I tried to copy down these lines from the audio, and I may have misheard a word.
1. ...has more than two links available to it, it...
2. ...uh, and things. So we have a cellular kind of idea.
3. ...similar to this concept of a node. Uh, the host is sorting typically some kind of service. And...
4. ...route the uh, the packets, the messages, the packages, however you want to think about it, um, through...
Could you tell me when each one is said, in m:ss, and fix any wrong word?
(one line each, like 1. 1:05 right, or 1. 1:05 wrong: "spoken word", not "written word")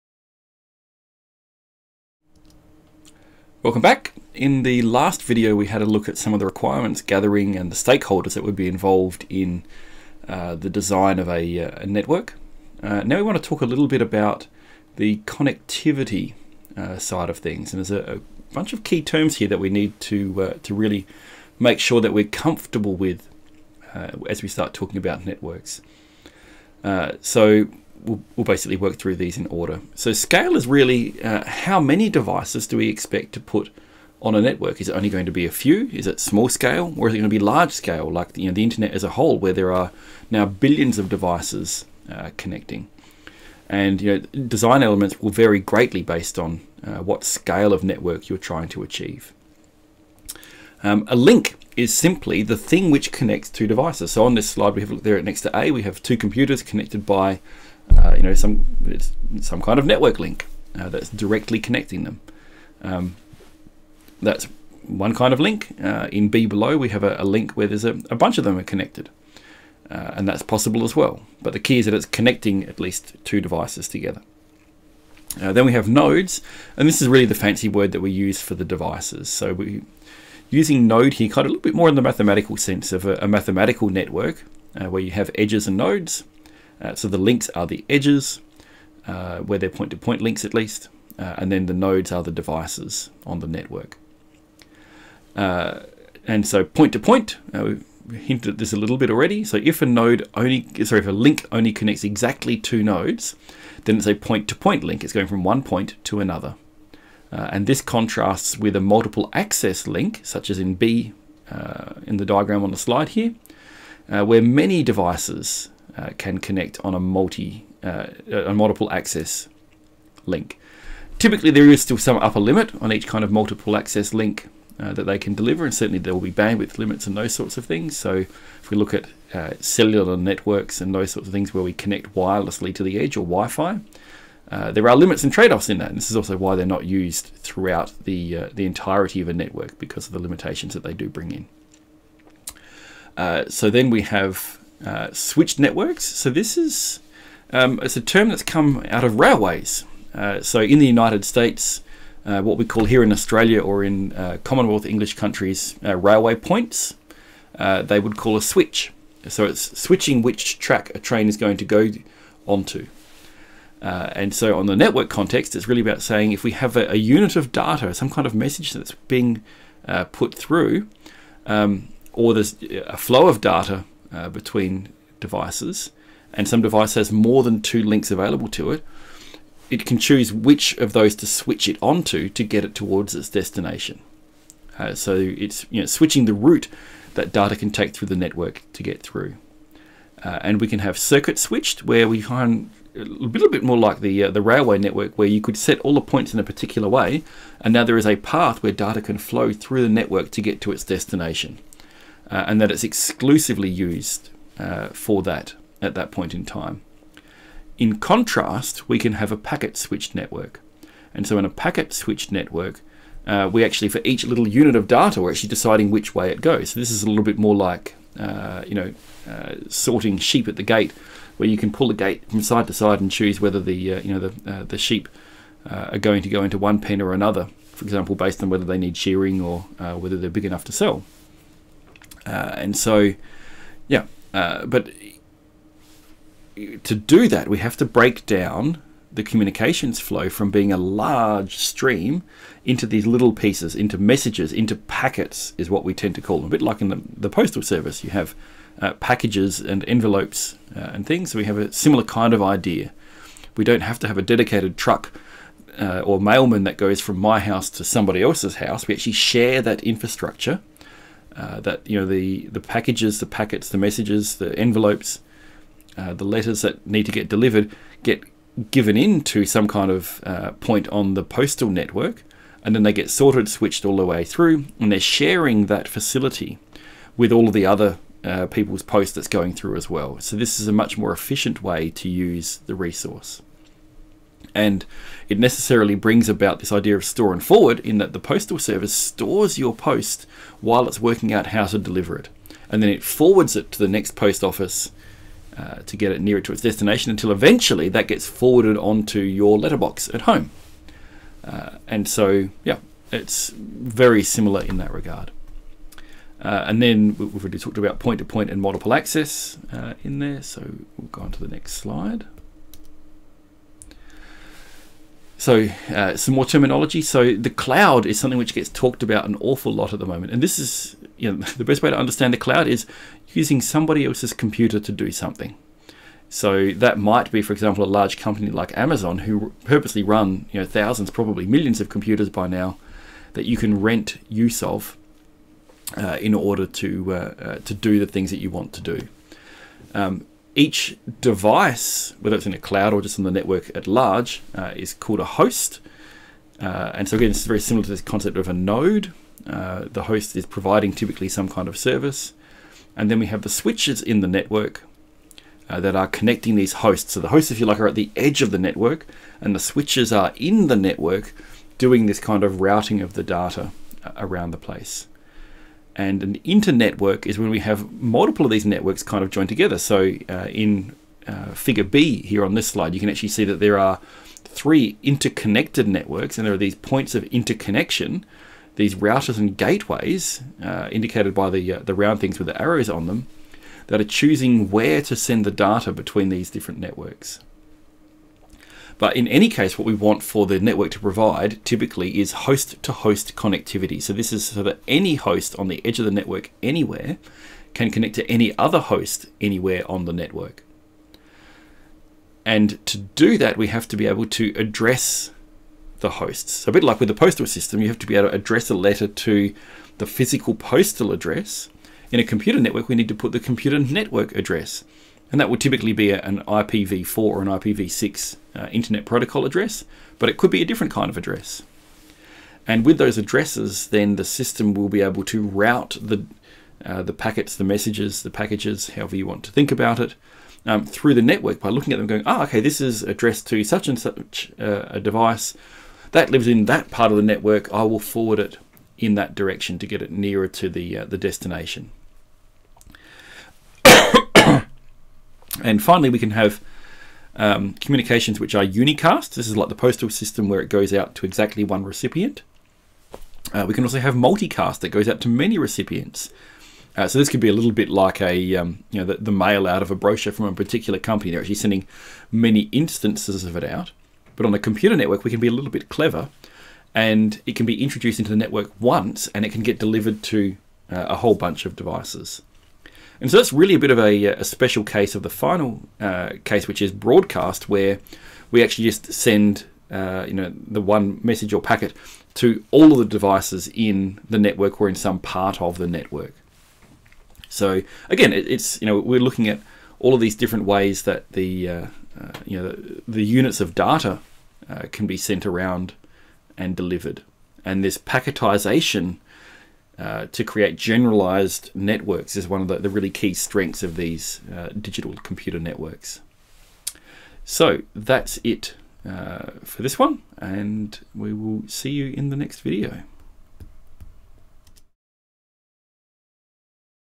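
1. 2:56 right
2. 4:10 wrong: "similar", not "cellular"
3. 5:47 wrong: "providing", not "sorting"
4. 7:05 right.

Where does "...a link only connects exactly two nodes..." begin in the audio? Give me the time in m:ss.
1:41.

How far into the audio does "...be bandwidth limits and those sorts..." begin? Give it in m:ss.
2:06.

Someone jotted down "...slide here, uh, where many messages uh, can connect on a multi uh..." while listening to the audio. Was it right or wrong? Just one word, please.
wrong.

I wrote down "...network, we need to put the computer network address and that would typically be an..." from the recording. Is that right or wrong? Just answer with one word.
right.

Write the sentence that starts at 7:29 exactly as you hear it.
This is like the postal system where it goes out to exactly one recipient.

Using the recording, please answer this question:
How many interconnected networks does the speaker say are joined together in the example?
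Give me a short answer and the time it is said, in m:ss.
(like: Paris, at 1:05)
3, at 6:14.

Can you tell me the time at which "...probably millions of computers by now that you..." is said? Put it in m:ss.
5:31.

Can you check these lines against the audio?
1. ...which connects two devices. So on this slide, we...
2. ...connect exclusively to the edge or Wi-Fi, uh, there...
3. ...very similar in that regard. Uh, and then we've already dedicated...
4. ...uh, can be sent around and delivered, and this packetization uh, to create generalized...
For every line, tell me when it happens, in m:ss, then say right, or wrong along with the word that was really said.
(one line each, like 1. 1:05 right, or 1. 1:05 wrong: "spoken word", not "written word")
1. 0:52 right
2. 2:11 wrong: "wirelessly", not "exclusively"
3. 5:03 wrong: "talked", not "dedicated"
4. 8:14 right.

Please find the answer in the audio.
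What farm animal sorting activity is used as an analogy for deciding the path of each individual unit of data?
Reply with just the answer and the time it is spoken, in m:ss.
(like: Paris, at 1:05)
Sorting sheep, at 3:39.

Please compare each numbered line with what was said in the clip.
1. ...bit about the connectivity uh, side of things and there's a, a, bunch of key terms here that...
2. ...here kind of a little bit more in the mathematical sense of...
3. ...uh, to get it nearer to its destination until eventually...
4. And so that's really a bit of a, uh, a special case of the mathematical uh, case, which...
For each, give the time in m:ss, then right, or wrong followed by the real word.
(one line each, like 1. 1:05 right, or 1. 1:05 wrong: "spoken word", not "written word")
1. 0:13 right
2. 1:21 right
3. 4:55 right
4. 7:53 wrong: "final", not "mathematical".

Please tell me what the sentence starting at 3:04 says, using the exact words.
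Uh, so it's you know, switching the route that data can take through the network to get through.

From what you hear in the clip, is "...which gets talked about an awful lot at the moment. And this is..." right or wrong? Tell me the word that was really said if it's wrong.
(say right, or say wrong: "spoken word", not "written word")
right.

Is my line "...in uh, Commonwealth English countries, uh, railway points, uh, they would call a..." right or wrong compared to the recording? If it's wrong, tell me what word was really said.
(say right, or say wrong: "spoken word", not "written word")
right.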